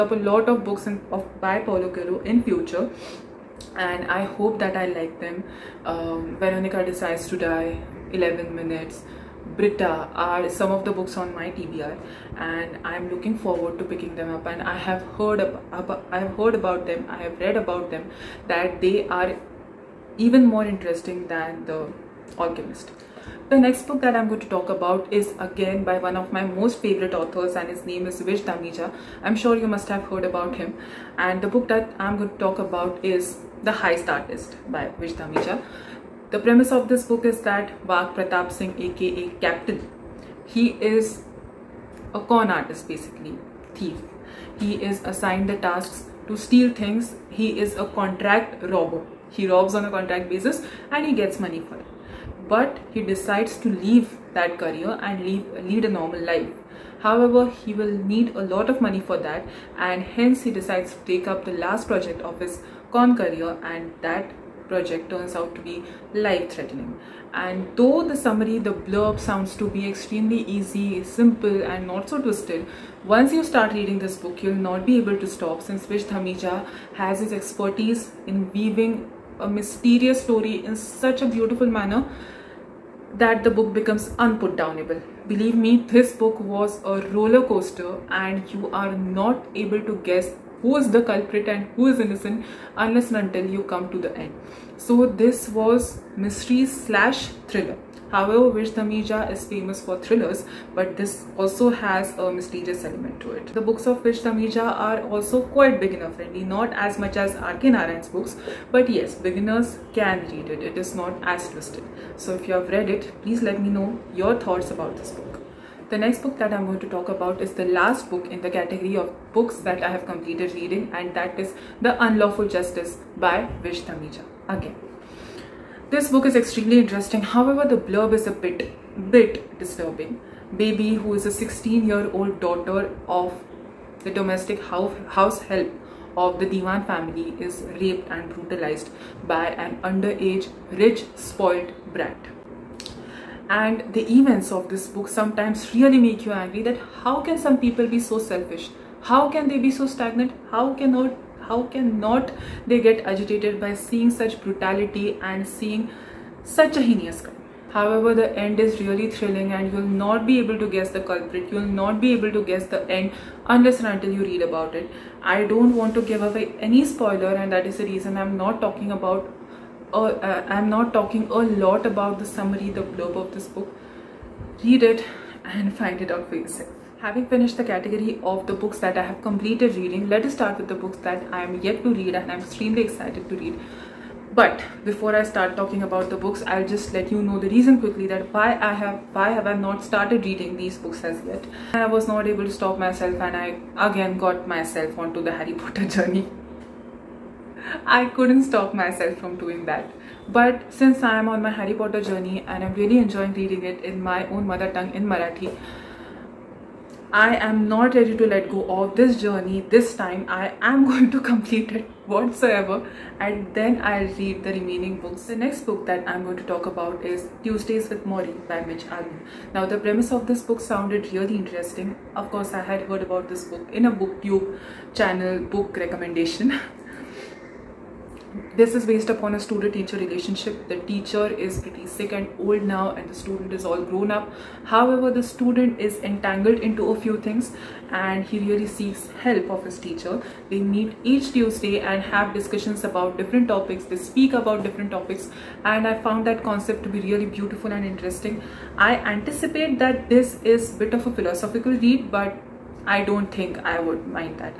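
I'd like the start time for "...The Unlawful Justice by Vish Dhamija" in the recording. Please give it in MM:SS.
02:01.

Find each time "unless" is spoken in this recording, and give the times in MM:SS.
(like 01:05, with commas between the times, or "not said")
01:32, 02:43.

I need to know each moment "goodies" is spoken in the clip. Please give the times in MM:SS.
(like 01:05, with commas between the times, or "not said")
not said.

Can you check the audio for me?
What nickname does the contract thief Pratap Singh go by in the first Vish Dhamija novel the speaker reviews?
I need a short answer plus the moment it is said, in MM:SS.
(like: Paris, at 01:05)
Captain, at 00:39.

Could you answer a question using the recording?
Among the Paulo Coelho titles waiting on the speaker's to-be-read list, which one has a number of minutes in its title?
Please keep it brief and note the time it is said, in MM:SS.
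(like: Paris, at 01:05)
11 Minutes, at 00:08.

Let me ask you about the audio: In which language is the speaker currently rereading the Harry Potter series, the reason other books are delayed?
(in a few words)
Marathi.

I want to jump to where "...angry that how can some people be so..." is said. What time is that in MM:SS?
02:26.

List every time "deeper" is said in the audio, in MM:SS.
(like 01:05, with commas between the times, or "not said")
not said.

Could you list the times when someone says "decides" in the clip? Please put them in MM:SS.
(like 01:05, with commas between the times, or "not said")
00:06, 00:53, 01:00.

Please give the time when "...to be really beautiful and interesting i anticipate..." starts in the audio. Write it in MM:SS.
04:06.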